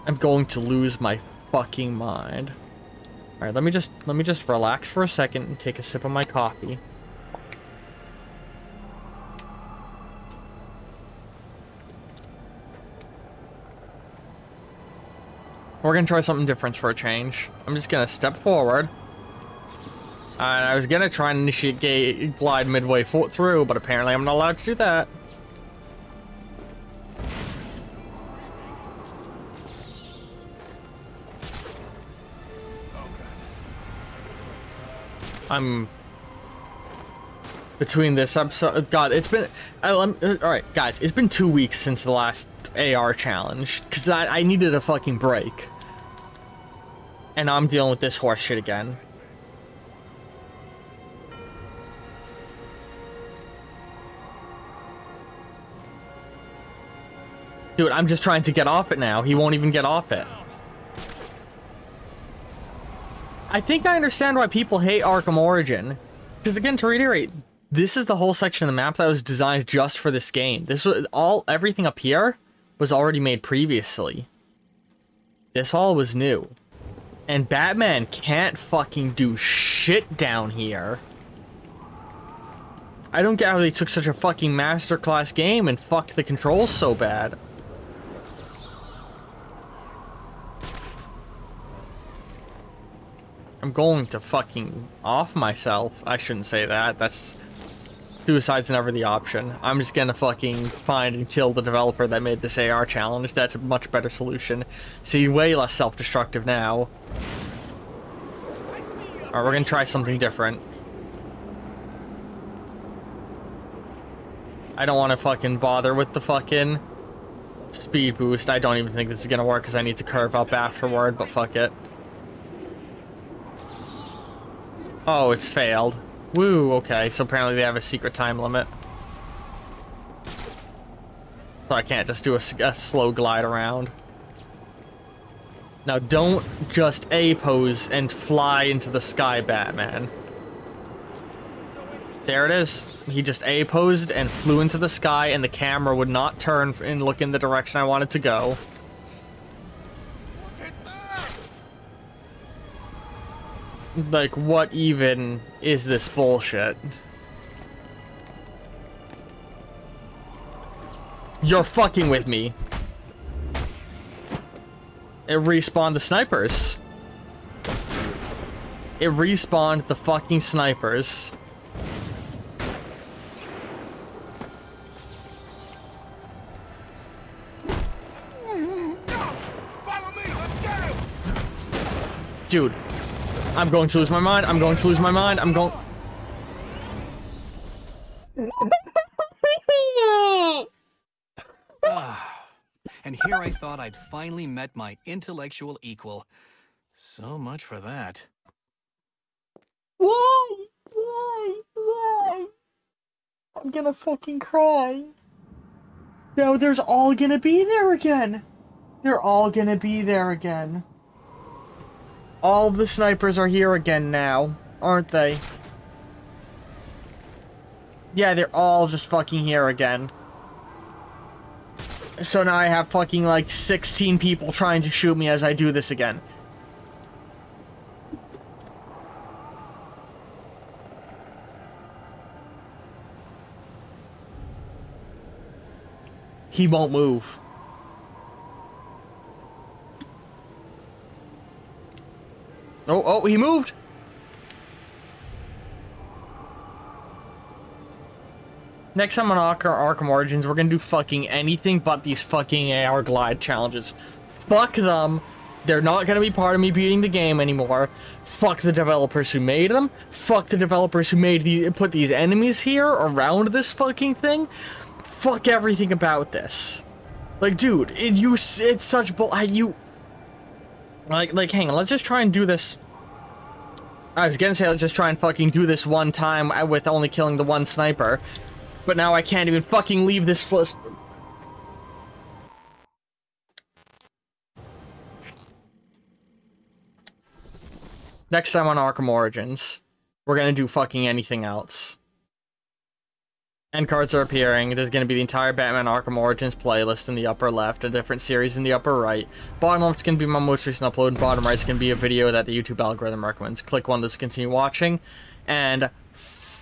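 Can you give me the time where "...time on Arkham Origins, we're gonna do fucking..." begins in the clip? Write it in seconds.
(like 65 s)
288 s.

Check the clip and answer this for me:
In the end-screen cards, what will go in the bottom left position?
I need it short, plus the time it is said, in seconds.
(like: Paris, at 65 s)
Most recent upload, at 300 s.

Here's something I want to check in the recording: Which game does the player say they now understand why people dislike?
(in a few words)
Arkham Origin.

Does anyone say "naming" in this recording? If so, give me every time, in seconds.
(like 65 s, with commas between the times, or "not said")
not said.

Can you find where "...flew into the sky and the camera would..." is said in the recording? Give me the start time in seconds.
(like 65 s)
144 s.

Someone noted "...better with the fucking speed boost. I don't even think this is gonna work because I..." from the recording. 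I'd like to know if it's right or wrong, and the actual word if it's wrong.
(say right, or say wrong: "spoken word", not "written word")
wrong: "bother", not "better".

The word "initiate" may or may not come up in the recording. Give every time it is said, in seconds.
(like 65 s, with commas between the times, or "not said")
21 s.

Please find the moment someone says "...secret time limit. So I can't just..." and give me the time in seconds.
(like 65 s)
127 s.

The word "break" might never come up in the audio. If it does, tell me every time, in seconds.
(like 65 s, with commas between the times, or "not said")
45 s.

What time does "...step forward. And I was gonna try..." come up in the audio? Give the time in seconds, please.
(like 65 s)
18 s.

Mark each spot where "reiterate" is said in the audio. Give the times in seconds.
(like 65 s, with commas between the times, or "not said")
66 s.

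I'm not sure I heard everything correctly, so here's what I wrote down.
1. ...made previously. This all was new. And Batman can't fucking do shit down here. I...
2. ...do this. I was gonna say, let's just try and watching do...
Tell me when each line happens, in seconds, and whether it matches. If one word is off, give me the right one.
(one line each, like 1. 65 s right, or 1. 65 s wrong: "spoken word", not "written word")
1. 73 s right
2. 272 s wrong: "fucking", not "watching".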